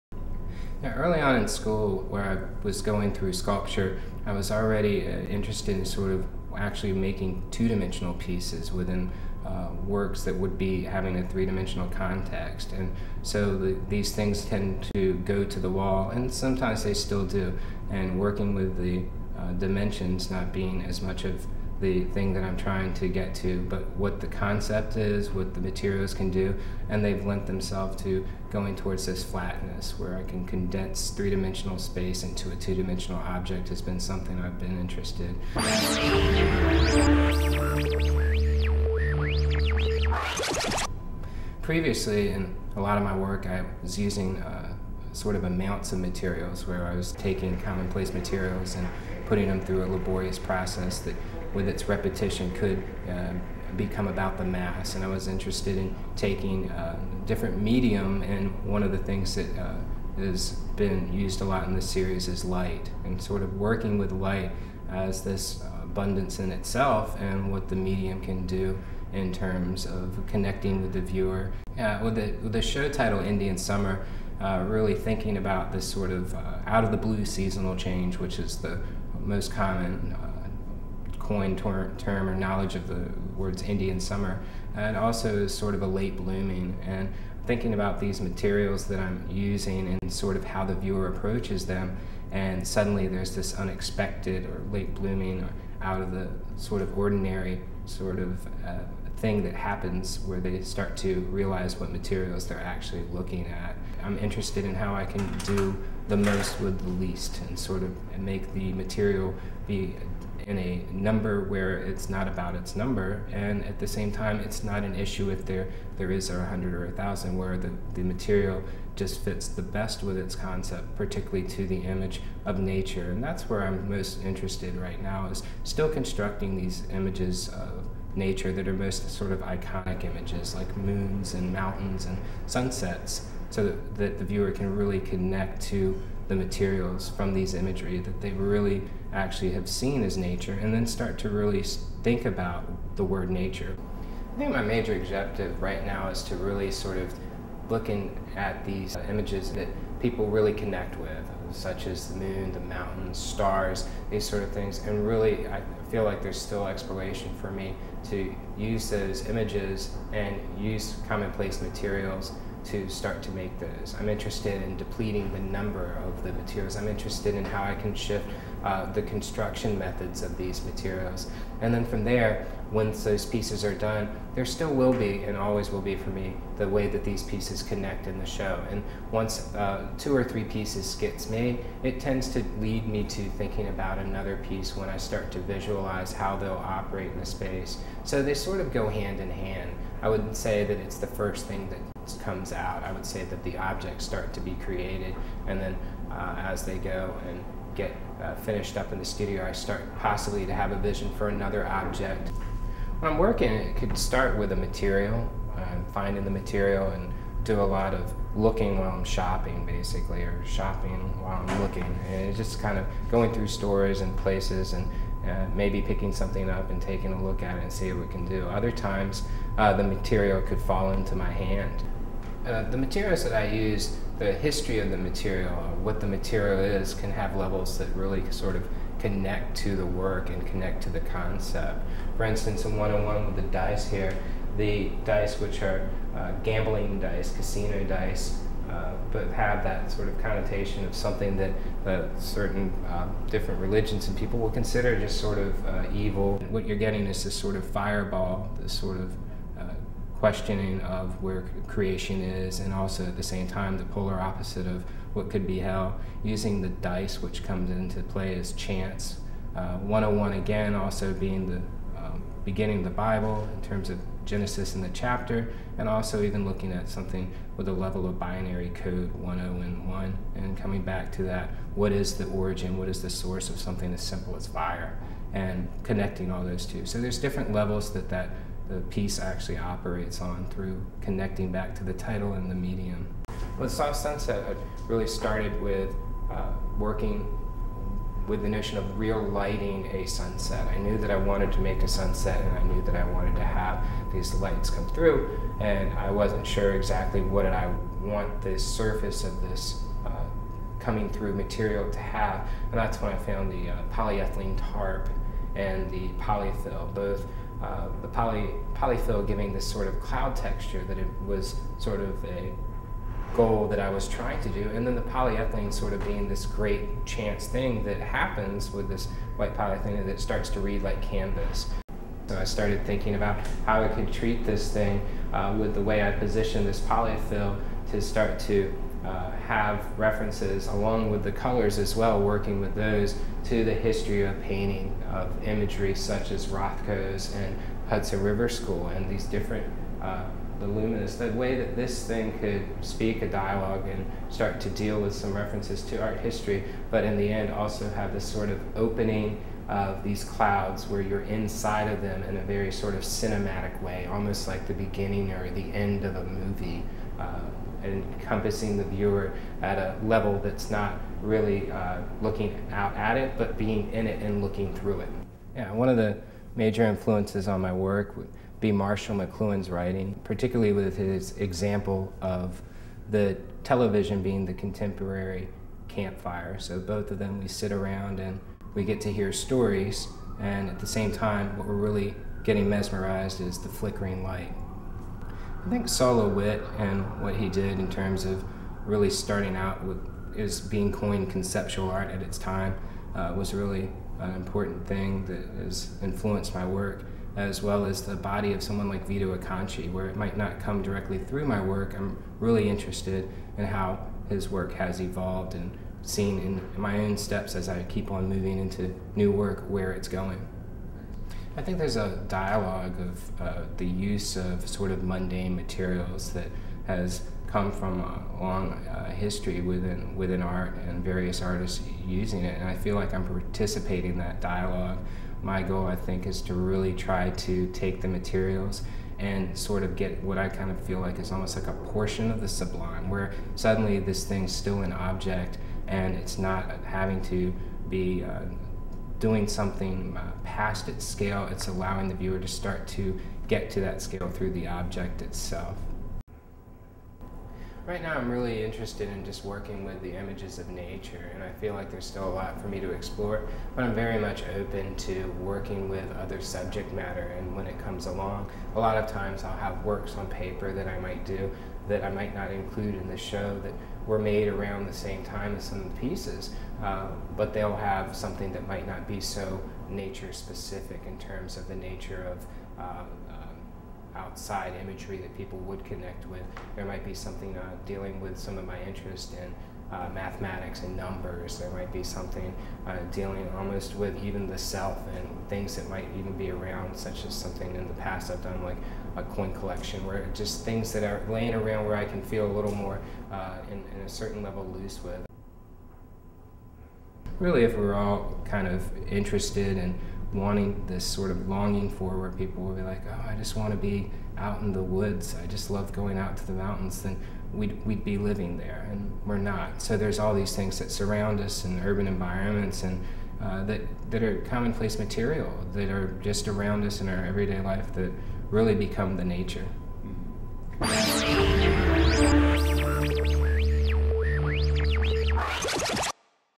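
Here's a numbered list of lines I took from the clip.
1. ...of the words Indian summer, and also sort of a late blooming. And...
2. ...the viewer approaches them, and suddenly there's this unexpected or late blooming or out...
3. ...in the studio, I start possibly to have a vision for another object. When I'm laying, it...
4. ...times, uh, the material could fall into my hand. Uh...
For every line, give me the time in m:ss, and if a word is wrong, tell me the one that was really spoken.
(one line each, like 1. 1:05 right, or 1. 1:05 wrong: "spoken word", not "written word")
1. 1:22 right
2. 1:30 right
3. 3:18 wrong: "working", not "laying"
4. 3:38 right.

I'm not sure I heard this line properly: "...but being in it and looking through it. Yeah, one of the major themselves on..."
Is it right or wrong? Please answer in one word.
wrong.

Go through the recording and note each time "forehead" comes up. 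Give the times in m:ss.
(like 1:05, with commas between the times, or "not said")
not said.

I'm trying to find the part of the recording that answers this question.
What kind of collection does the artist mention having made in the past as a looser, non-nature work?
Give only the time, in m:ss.
8:09.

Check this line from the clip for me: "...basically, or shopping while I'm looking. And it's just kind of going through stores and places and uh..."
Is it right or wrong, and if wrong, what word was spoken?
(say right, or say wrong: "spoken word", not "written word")
right.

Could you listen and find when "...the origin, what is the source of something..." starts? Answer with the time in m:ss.
4:32.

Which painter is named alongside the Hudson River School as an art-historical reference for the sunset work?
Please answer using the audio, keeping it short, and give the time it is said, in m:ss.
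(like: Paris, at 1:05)
Rothko, at 5:36.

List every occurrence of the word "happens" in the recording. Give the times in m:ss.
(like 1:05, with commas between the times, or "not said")
1:39, 5:17.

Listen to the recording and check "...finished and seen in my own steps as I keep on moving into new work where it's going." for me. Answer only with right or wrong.
wrong.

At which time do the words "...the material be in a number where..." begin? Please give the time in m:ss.
1:48.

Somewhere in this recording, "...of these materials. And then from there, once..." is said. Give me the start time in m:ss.
2:50.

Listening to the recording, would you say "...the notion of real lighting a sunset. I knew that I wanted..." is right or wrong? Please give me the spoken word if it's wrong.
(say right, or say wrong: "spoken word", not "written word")
right.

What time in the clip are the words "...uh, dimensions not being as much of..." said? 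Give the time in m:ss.
0:19.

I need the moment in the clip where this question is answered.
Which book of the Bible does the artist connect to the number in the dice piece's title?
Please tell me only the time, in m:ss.
4:24.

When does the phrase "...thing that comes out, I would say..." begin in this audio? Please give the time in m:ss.
3:11.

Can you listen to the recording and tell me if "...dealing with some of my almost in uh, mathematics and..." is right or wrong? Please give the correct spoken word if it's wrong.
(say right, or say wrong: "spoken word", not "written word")
wrong: "interest", not "almost".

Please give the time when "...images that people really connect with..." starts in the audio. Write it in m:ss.
2:29.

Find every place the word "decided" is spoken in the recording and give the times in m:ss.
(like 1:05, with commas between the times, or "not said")
not said.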